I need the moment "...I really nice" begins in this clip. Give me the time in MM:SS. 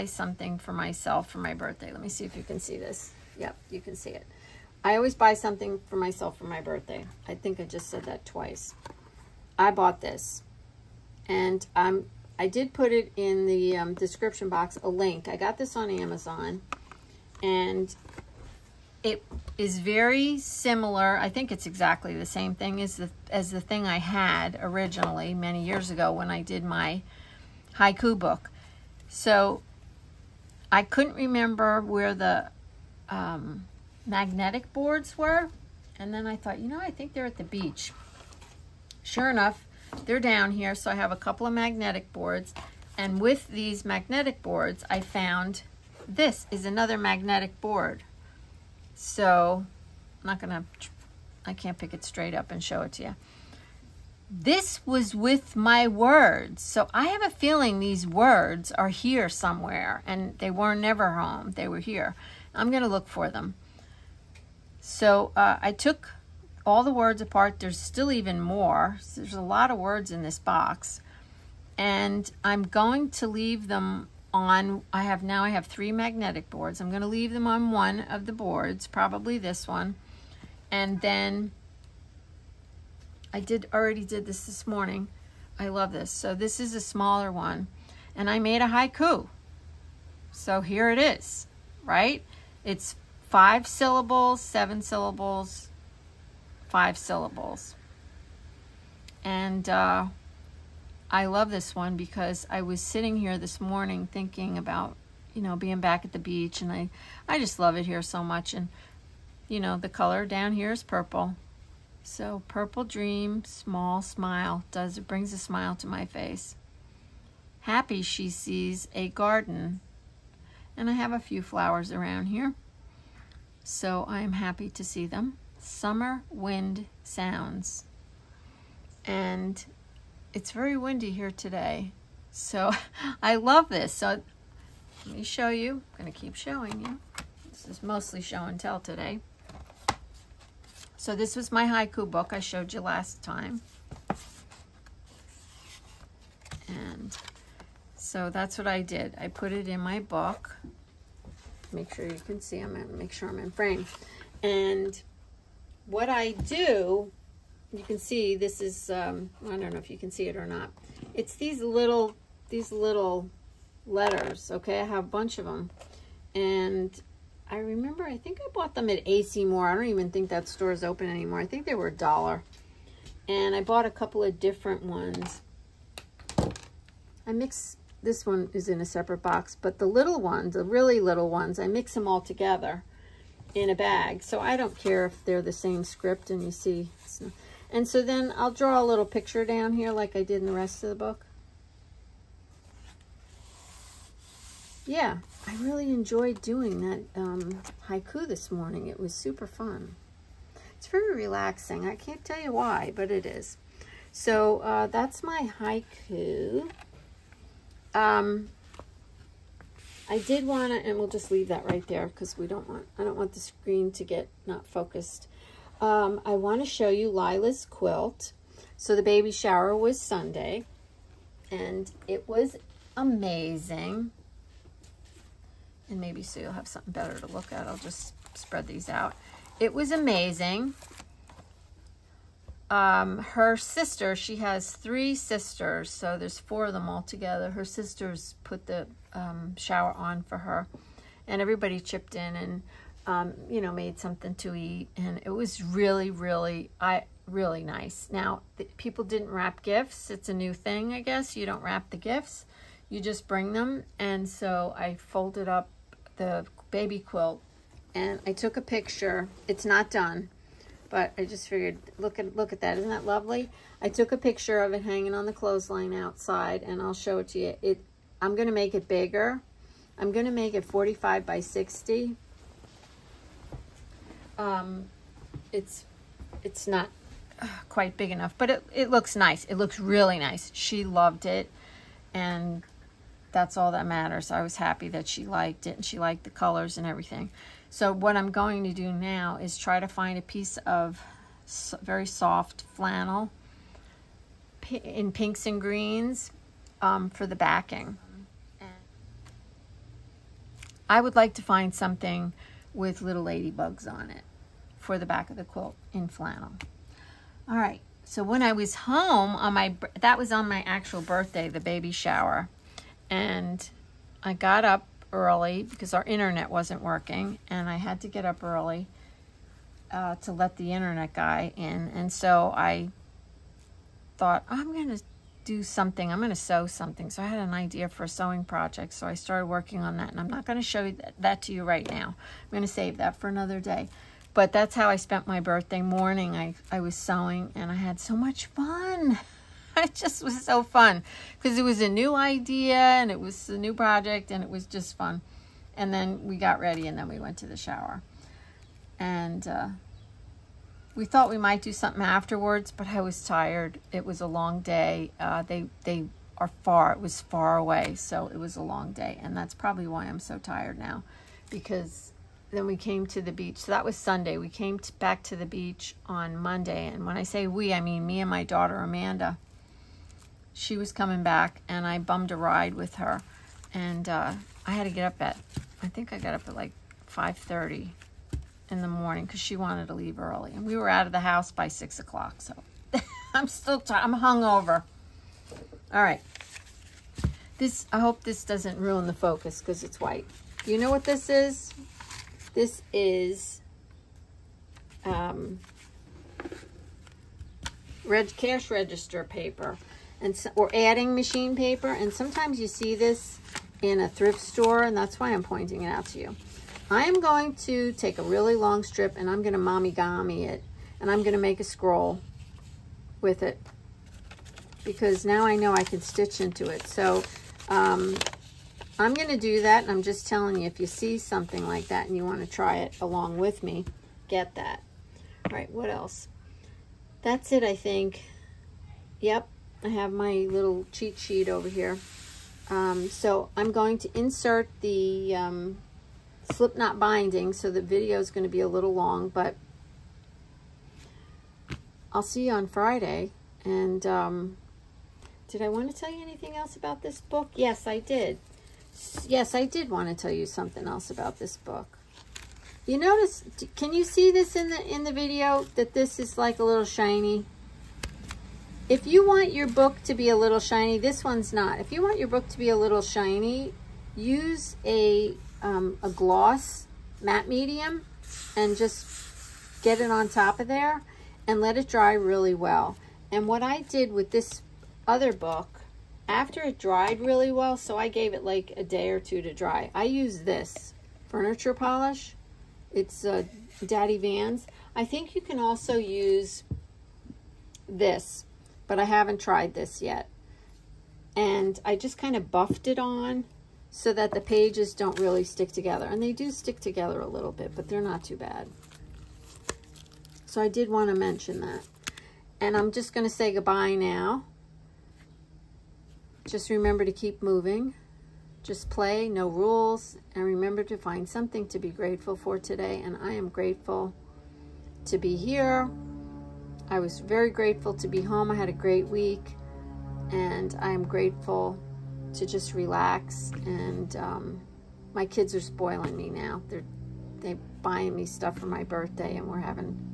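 04:06.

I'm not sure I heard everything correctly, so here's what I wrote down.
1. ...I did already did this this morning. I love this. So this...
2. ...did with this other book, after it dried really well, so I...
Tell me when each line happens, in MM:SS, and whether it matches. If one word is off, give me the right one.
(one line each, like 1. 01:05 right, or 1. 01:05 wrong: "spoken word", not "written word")
1. 01:23 right
2. 07:53 right.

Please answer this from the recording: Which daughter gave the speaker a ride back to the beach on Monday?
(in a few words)
Amanda.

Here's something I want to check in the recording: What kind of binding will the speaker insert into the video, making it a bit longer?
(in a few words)
slip knot binding.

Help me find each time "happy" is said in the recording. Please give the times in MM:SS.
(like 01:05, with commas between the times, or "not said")
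01:57, 02:04, 04:44.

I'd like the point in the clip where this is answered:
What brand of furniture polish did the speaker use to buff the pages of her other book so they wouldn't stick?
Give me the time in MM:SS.
08:03.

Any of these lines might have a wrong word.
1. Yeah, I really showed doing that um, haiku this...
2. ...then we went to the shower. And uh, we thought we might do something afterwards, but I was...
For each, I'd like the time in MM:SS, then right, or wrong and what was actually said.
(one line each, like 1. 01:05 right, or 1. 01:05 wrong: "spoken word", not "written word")
1. 03:14 wrong: "enjoyed", not "showed"
2. 05:46 right.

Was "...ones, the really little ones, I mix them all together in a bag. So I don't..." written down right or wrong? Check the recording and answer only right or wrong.
right.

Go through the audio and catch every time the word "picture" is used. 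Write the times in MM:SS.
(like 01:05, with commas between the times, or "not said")
03:09, 04:18, 04:24.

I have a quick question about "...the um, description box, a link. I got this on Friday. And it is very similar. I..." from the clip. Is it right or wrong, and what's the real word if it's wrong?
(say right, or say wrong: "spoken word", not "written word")
wrong: "Amazon", not "Friday".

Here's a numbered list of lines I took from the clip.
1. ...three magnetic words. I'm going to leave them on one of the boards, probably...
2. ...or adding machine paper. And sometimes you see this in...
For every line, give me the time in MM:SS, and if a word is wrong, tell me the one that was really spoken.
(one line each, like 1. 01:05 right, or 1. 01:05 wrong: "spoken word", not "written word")
1. 01:15 wrong: "boards", not "words"
2. 06:40 right.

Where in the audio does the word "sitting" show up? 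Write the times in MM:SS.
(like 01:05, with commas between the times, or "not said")
01:42.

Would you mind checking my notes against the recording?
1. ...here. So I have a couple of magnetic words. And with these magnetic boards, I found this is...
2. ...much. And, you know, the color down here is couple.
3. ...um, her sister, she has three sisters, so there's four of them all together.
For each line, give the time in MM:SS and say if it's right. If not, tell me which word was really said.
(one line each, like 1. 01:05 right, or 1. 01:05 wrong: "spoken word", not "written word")
1. 00:40 wrong: "boards", not "words"
2. 01:48 wrong: "purple", not "couple"
3. 03:52 right.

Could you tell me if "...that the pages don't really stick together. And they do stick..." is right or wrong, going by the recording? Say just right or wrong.
right.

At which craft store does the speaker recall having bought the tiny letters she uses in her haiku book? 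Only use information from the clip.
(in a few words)
AC Moore.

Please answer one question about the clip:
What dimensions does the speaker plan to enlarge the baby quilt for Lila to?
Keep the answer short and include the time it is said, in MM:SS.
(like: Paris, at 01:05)
45 by 60, at 04:30.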